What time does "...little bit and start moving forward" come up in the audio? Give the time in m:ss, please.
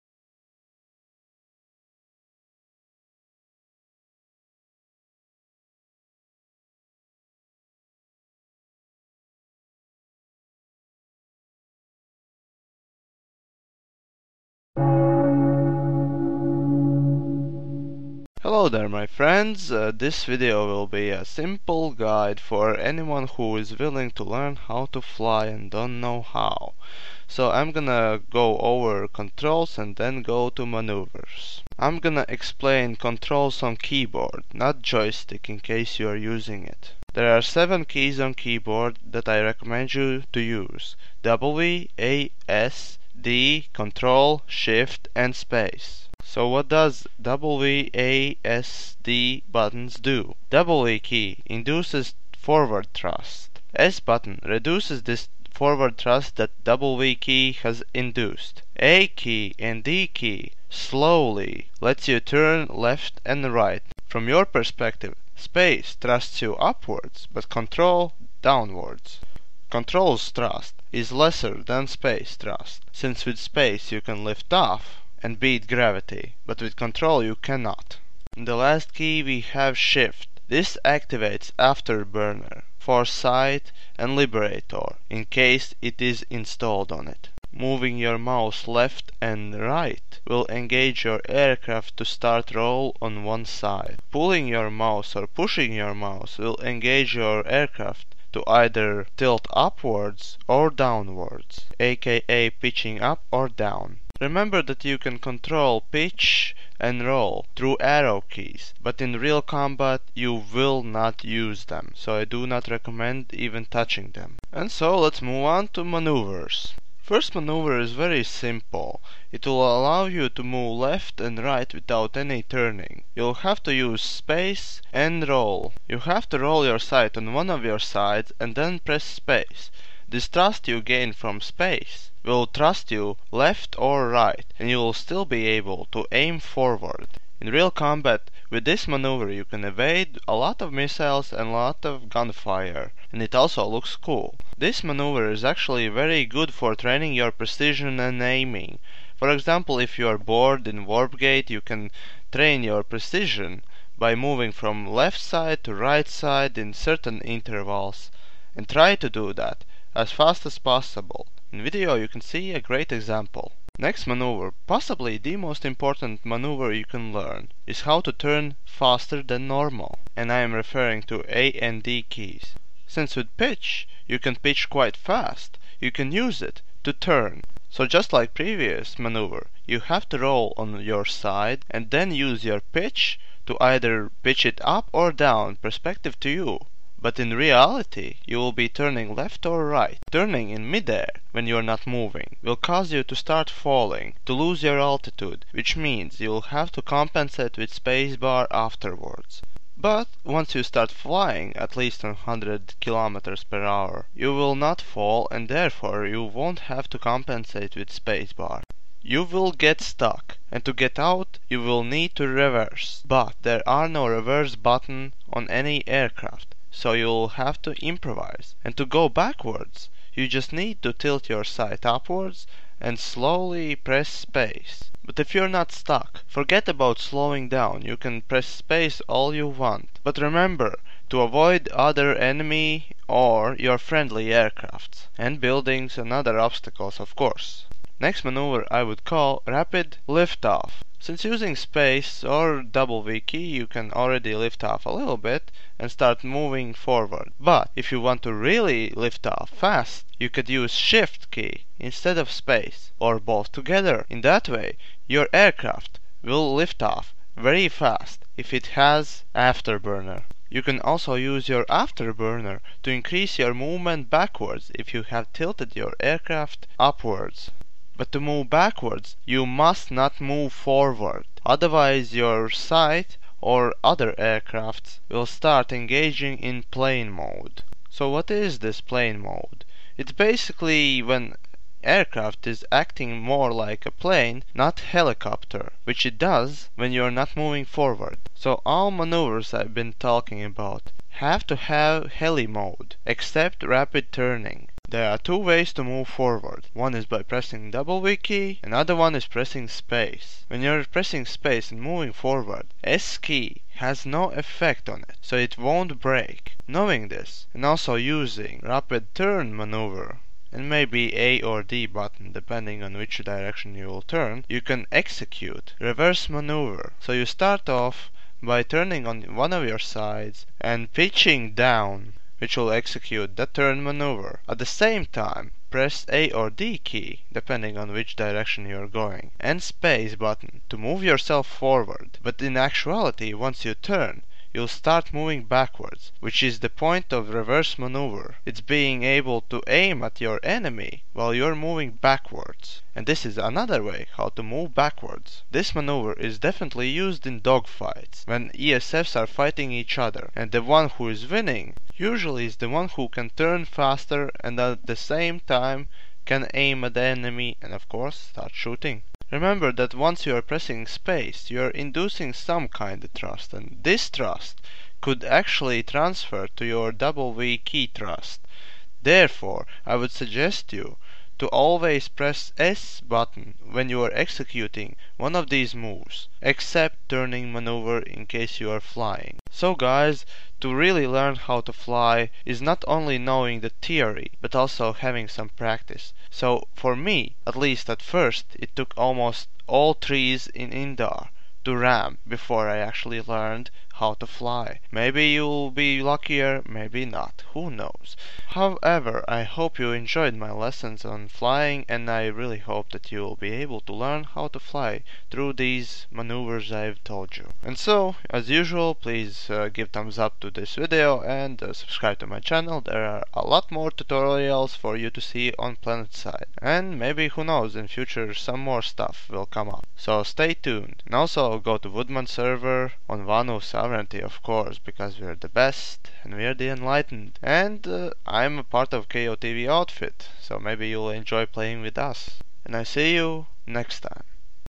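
4:04.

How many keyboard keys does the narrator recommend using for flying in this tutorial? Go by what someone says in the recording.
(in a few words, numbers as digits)
7.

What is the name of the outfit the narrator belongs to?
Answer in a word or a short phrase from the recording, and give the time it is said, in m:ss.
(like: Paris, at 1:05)
KOTV, at 7:09.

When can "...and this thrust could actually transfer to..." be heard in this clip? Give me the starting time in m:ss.
6:03.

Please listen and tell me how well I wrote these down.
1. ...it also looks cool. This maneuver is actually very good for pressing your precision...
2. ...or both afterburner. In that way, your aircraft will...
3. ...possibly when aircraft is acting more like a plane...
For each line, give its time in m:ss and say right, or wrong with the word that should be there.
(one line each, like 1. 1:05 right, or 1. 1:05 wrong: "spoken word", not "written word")
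1. 2:23 wrong: "training", not "pressing"
2. 4:12 wrong: "together", not "afterburner"
3. 4:40 wrong: "basically", not "possibly".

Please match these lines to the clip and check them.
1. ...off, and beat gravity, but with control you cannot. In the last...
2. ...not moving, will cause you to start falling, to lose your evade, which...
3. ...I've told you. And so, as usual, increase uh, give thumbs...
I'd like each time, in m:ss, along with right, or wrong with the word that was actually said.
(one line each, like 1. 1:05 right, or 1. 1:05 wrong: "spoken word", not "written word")
1. 1:14 right
2. 3:11 wrong: "altitude", not "evade"
3. 6:46 wrong: "please", not "increase".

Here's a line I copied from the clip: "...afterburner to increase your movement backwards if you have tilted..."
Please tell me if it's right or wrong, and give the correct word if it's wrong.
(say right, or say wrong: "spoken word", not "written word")
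right.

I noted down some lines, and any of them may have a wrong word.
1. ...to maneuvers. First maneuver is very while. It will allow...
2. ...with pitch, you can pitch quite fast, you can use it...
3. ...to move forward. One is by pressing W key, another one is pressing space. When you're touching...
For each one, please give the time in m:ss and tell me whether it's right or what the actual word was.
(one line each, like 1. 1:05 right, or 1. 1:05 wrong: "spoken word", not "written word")
1. 1:55 wrong: "simple", not "while"
2. 2:53 right
3. 4:55 wrong: "pressing", not "touching".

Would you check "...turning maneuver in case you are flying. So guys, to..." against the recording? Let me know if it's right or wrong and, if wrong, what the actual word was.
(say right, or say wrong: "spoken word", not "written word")
right.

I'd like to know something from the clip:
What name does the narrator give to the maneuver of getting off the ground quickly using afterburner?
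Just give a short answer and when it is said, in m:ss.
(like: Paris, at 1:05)
Rapid liftoff, at 3:59.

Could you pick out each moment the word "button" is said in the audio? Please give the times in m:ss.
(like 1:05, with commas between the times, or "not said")
0:49, 0:53, 3:34, 5:11, 5:30, 6:13.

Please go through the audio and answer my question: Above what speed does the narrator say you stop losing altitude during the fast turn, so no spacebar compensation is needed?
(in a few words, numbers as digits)
100 kilometers per hour.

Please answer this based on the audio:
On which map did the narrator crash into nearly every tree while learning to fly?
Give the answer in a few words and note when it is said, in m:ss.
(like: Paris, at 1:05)
Indar, at 6:30.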